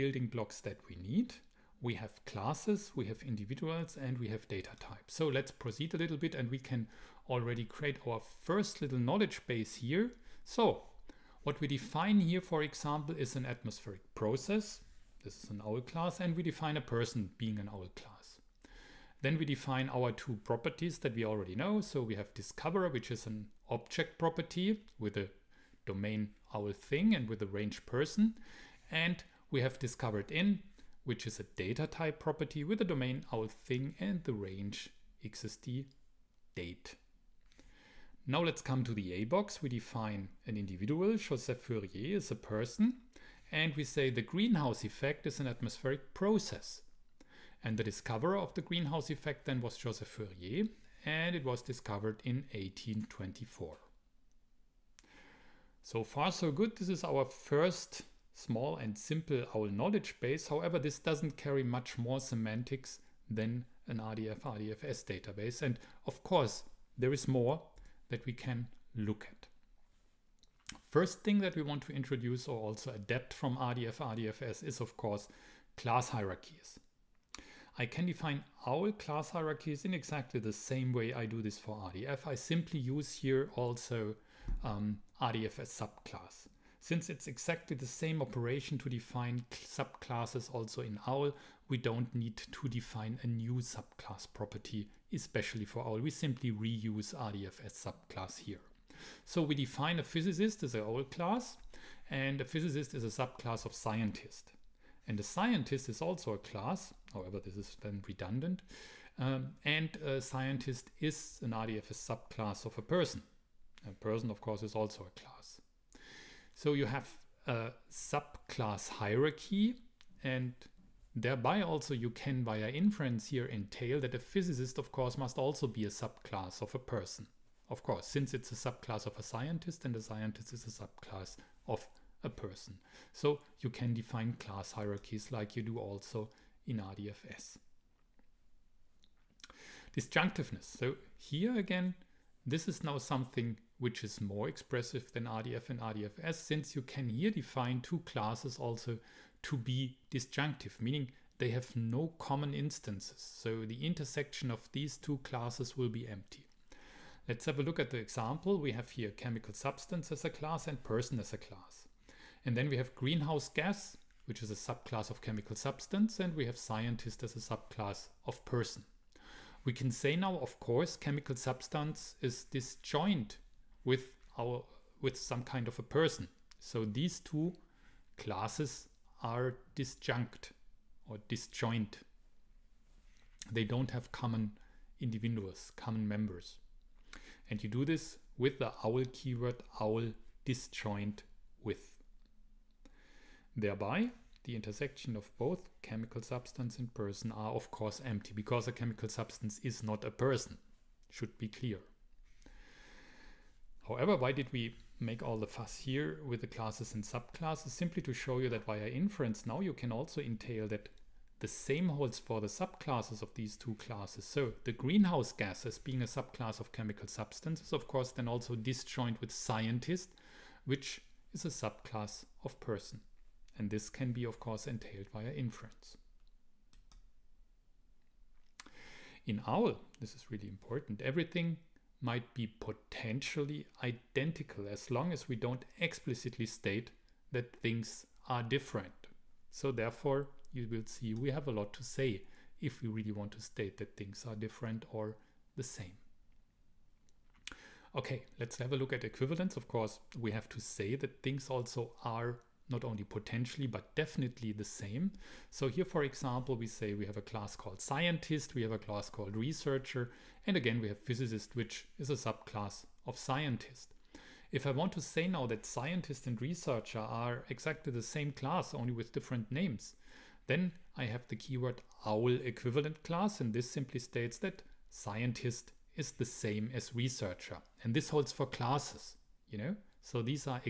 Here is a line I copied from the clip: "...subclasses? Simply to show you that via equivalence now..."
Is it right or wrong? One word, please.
wrong.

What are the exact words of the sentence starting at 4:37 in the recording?
And this holds for classes, you know?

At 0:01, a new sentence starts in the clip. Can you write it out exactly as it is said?
We have classes, we have individuals, and we have data types.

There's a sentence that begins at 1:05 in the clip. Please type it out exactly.
And of course, there is more that we can look at.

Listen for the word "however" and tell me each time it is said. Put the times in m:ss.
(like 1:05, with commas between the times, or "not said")
1:00, 1:47, 3:23.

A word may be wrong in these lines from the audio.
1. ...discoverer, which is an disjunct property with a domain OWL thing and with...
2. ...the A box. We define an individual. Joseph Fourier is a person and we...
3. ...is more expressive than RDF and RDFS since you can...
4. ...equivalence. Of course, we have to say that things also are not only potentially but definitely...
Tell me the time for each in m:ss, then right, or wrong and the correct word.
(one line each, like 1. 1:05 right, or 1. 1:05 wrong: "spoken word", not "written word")
1. 0:22 wrong: "object", not "disjunct"
2. 0:38 right
3. 2:24 right
4. 4:09 right.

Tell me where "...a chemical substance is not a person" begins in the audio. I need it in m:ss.
3:18.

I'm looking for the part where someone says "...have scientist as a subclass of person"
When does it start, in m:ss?
2:46.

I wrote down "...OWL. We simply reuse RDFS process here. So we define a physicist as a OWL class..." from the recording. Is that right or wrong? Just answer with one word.
wrong.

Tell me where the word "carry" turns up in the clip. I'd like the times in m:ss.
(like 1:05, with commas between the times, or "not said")
1:01.